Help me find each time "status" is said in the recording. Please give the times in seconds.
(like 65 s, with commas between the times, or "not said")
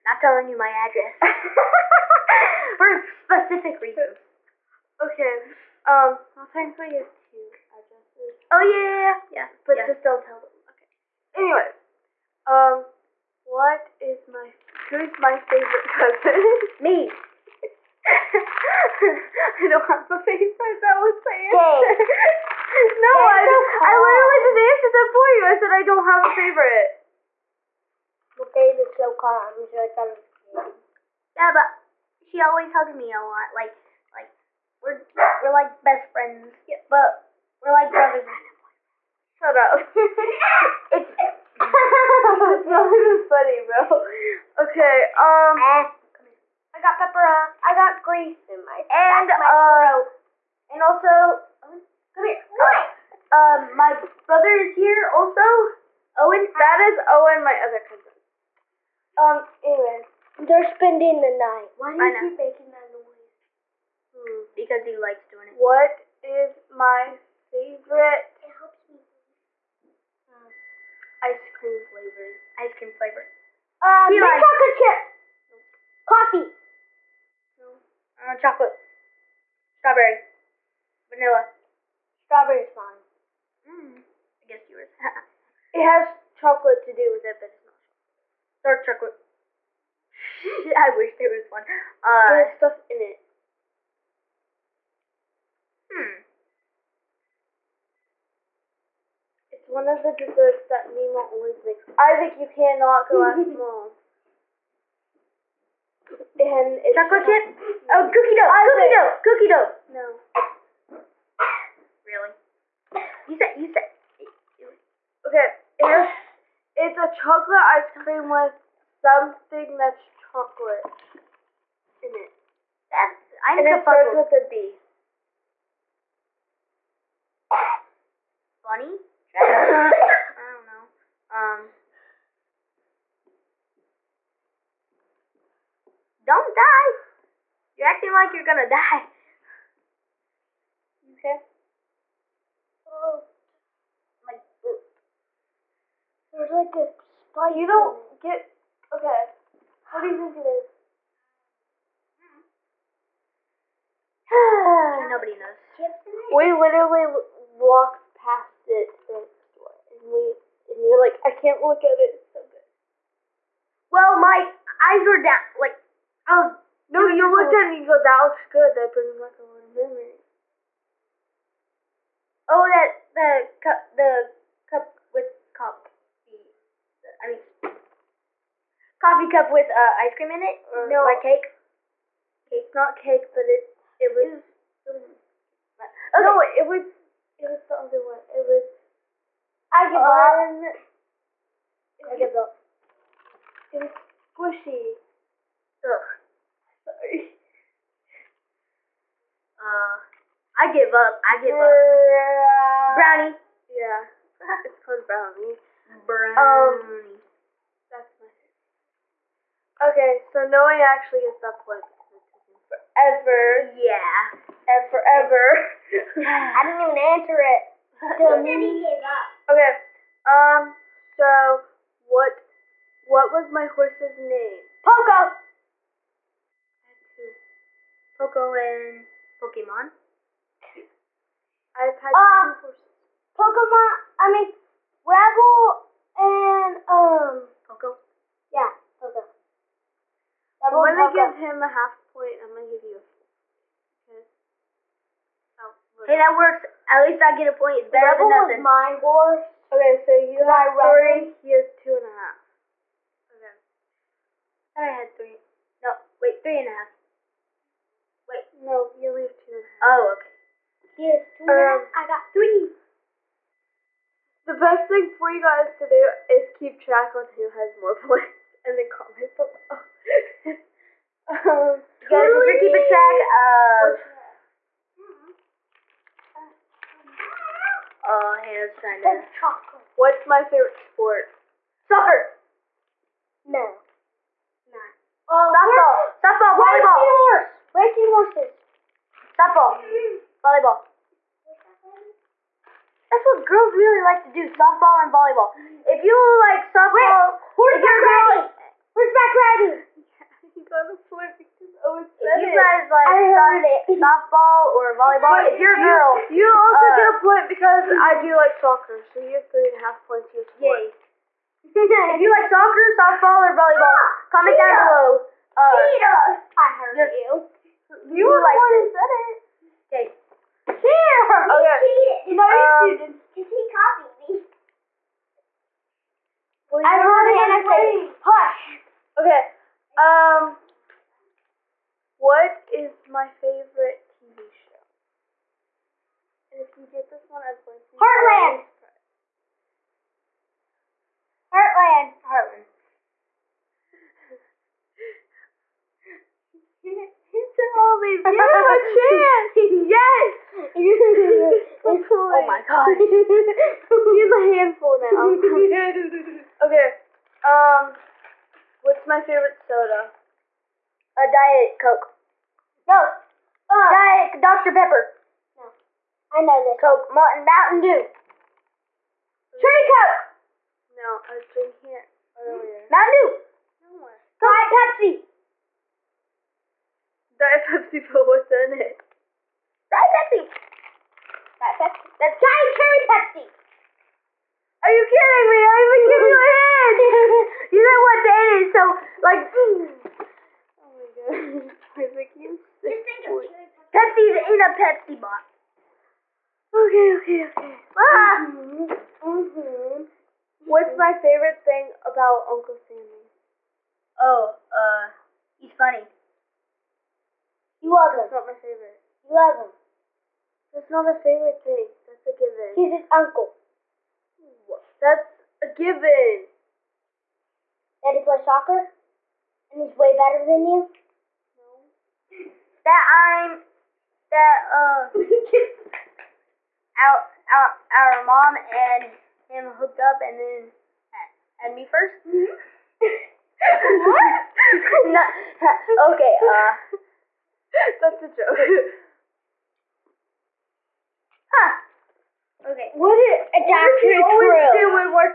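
not said.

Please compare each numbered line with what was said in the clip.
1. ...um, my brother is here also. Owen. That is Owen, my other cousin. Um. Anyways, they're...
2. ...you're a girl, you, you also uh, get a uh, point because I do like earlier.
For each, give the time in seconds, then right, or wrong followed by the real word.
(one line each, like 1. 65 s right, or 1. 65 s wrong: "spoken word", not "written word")
1. 53 s right
2. 305 s wrong: "soccer", not "earlier".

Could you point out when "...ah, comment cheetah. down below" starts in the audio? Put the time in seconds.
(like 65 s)
313 s.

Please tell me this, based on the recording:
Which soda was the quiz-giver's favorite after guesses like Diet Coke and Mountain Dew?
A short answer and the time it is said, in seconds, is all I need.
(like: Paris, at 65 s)
Diet Cherry Pepsi, at 382 s.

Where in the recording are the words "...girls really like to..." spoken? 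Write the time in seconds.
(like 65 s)
293 s.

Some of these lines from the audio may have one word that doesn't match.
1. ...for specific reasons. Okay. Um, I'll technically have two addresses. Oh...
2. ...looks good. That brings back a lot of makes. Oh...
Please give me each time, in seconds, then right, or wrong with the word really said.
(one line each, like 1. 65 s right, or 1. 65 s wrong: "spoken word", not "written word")
1. 2 s right
2. 168 s wrong: "memories", not "makes".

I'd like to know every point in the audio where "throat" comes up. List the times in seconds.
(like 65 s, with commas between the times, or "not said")
50 s, 142 s.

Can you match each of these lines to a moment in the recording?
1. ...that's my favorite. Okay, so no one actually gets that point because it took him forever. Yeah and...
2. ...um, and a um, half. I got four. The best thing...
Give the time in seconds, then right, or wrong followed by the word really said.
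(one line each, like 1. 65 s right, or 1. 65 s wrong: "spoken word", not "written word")
1. 207 s right
2. 261 s wrong: "three", not "four".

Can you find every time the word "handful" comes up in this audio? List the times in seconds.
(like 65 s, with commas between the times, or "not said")
354 s.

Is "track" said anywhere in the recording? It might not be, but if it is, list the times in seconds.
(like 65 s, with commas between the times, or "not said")
266 s, 272 s.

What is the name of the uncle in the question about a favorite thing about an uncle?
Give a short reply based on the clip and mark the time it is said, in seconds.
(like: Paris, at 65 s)
Uncle Sammy, at 402 s.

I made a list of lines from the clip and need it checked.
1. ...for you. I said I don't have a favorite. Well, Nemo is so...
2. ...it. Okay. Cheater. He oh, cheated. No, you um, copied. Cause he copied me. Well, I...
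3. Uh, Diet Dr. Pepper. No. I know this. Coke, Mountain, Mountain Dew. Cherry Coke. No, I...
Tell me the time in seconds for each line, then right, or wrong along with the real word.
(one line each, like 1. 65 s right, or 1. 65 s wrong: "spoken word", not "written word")
1. 25 s wrong: "Gabe", not "Nemo"
2. 319 s wrong: "cheated", not "copied"
3. 363 s right.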